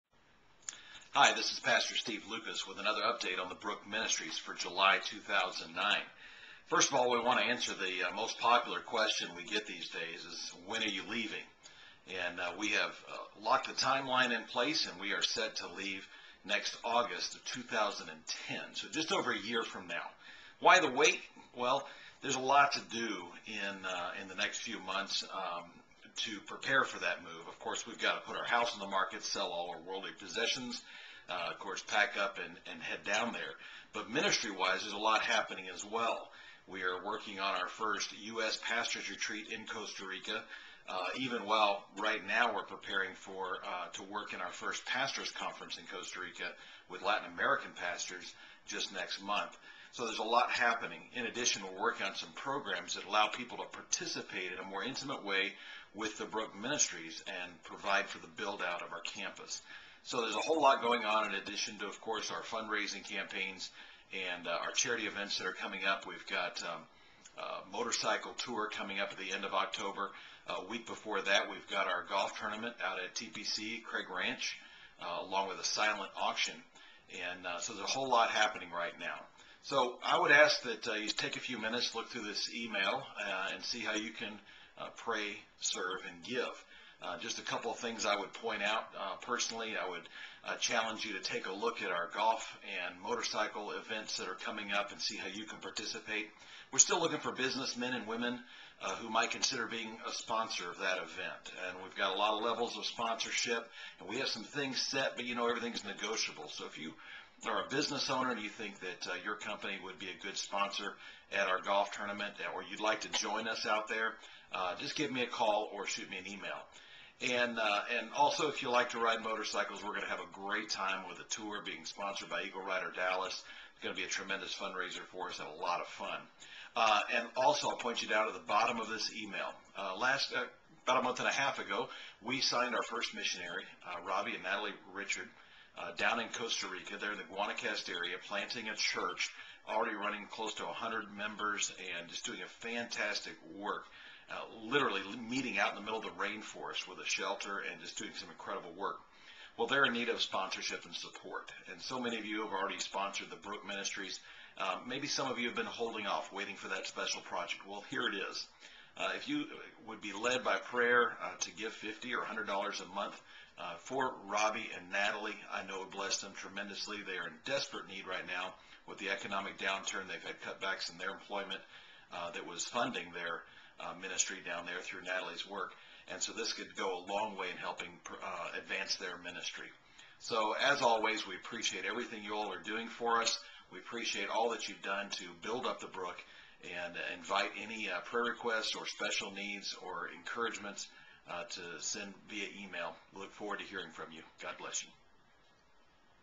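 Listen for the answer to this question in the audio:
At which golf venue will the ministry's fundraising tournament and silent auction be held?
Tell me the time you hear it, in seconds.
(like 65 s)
73 s.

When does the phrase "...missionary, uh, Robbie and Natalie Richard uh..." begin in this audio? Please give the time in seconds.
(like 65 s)
133 s.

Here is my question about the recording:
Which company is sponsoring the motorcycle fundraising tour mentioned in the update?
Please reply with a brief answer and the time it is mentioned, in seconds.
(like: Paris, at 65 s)
Eagle Rider Dallas, at 122 s.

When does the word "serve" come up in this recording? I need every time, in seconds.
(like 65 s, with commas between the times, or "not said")
85 s.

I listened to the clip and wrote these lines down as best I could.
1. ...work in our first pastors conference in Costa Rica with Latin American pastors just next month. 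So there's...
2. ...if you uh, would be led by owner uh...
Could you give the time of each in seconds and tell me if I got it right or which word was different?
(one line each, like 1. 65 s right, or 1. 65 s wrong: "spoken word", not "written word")
1. 44 s right
2. 159 s wrong: "prayer", not "owner".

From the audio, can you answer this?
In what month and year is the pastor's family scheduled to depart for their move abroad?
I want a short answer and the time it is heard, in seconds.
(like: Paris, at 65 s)
August 2010, at 16 s.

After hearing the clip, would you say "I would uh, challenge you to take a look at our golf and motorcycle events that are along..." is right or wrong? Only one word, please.
wrong.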